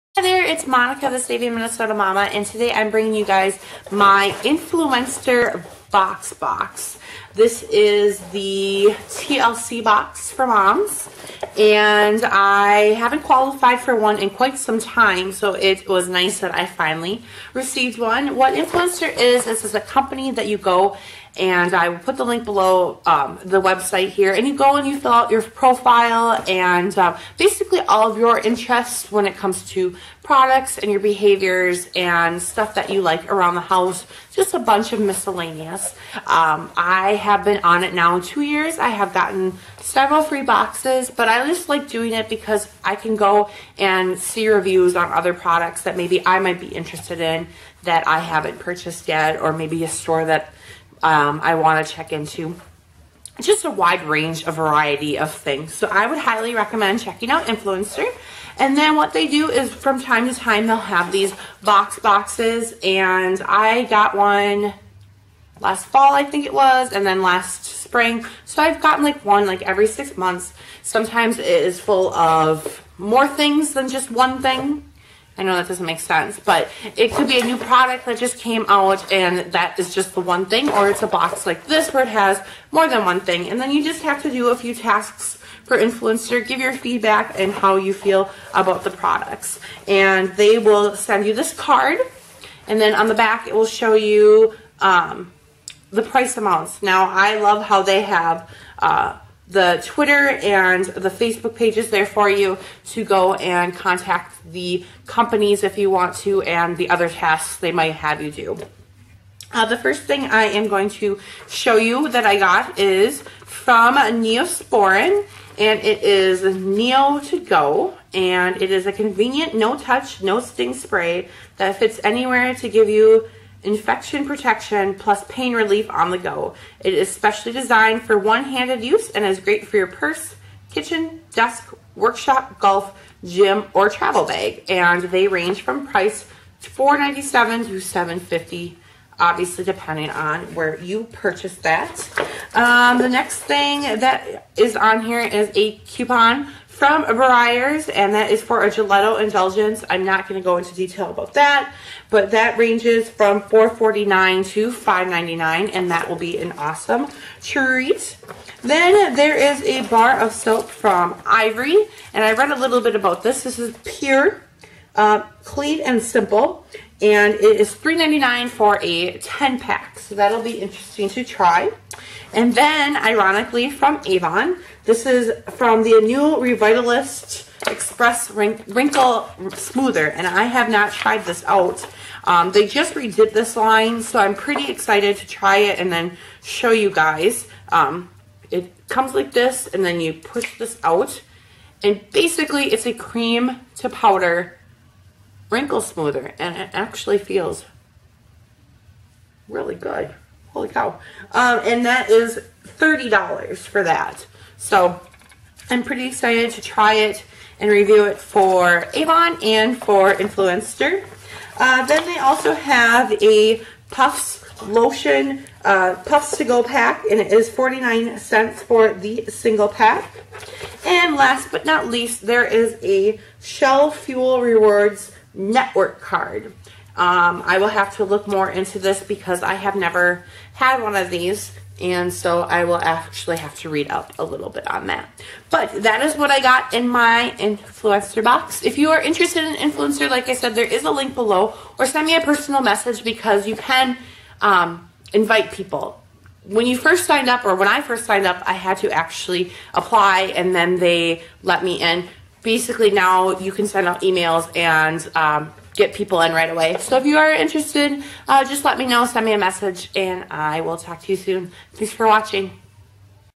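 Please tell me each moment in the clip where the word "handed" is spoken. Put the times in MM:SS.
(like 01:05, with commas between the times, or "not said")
02:08.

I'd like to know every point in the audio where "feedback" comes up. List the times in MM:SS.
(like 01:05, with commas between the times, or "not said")
01:26.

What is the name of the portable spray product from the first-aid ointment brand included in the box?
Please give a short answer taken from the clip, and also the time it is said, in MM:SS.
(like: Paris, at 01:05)
Neo to Go, at 01:56.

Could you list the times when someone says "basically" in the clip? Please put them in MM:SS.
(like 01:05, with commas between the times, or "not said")
00:27, 03:12, 04:12.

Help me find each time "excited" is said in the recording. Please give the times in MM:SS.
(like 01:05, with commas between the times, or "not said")
03:04, 03:26.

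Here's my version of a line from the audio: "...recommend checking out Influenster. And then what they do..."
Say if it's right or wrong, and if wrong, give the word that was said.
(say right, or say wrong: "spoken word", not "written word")
right.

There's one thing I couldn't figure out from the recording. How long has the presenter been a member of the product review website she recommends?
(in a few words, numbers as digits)
2 years.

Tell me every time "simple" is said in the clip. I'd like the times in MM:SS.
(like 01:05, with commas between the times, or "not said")
02:46.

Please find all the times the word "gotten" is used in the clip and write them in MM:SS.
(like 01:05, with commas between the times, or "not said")
00:39, 01:08.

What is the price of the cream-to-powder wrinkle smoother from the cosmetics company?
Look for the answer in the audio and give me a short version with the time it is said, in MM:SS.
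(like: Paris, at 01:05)
$30, at 03:22.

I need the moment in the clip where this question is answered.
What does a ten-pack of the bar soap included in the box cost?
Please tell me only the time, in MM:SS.
02:47.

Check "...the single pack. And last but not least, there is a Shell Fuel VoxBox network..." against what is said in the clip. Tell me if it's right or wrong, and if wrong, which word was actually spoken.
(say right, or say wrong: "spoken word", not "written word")
wrong: "Rewards", not "VoxBox".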